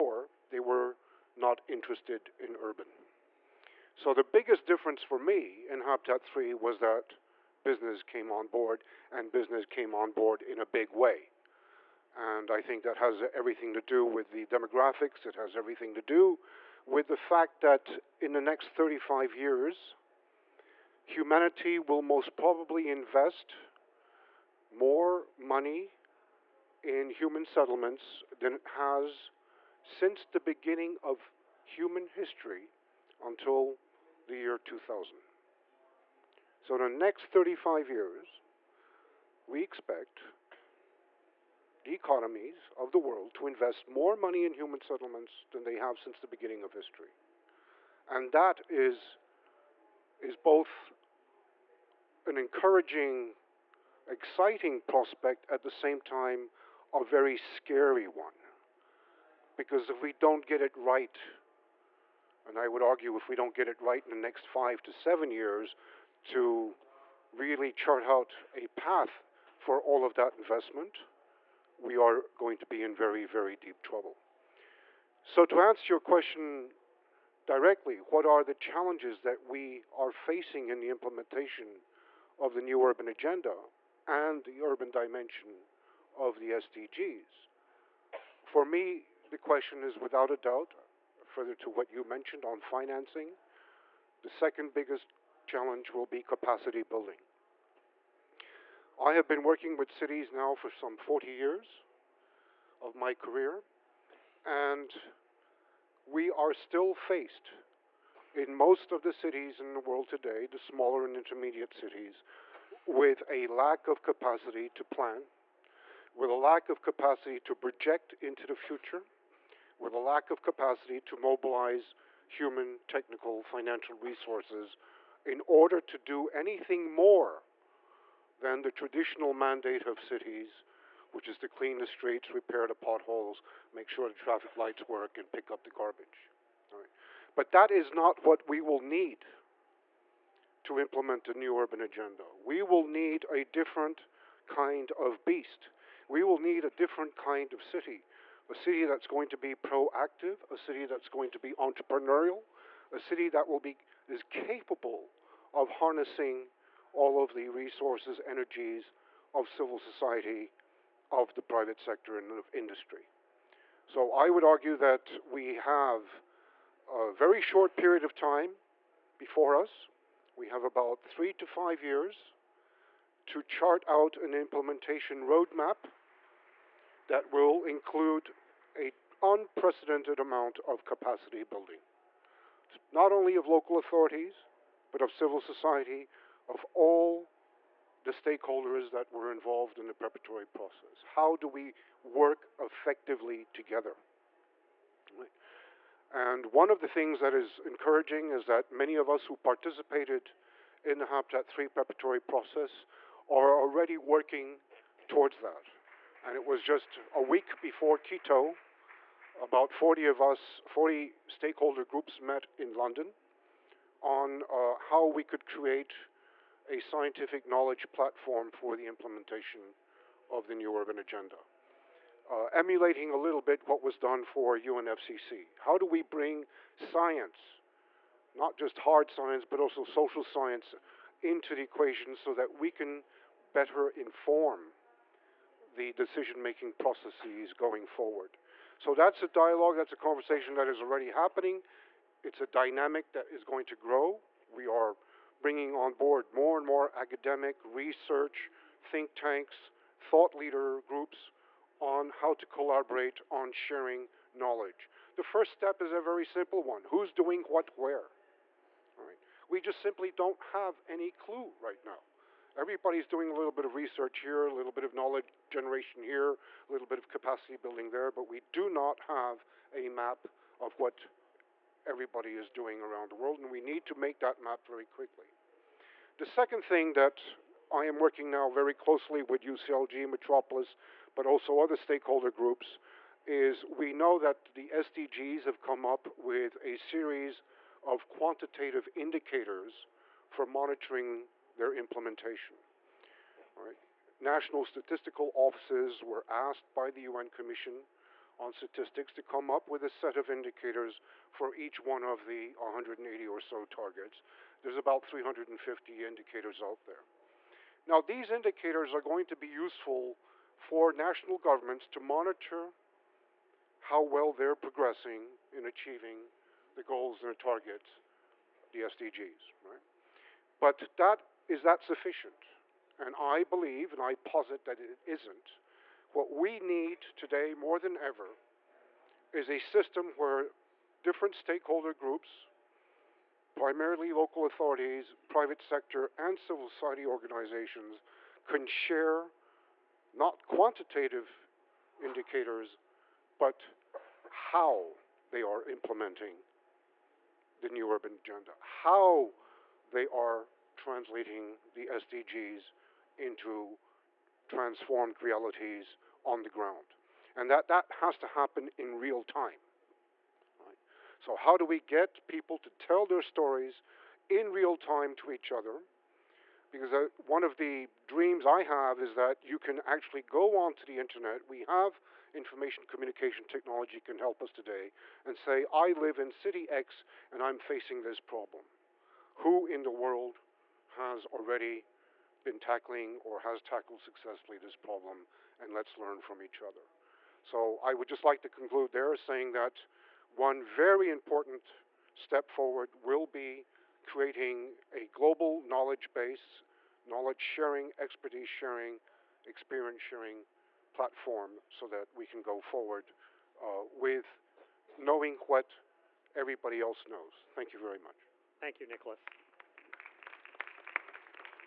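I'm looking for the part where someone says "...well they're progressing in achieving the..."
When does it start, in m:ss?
5:14.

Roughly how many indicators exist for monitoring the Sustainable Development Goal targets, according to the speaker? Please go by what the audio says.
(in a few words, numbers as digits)
350.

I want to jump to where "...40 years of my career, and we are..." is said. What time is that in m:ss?
1:40.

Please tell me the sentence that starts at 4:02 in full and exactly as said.
It's a dynamic that is going to grow.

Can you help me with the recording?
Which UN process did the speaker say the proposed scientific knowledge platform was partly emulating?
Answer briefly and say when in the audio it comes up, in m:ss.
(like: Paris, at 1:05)
UNFCCC, at 3:44.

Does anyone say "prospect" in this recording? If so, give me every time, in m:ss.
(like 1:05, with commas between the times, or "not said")
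0:54.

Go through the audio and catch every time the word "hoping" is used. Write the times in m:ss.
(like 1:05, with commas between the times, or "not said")
not said.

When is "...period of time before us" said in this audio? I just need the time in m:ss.
2:47.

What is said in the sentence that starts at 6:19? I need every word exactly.
Who in the world has already been tackling or has tackled successfully this problem, and let's learn from each other.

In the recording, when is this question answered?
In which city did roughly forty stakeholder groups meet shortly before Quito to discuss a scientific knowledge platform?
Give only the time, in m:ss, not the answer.
3:32.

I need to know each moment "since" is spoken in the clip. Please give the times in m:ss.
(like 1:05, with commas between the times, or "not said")
0:29, 0:45.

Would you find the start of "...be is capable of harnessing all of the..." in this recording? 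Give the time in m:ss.
2:33.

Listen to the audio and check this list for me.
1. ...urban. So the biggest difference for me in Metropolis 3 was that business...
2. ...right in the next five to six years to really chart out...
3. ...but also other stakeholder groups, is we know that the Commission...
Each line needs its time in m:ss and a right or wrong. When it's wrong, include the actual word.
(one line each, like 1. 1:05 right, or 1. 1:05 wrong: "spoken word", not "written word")
1. 0:02 wrong: "Habitat", not "Metropolis"
2. 1:03 wrong: "seven", not "six"
3. 4:41 wrong: "SDGs", not "Commission".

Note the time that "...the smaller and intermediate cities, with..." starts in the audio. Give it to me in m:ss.
1:50.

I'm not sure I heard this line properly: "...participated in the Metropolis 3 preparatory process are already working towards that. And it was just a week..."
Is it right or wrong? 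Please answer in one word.
wrong.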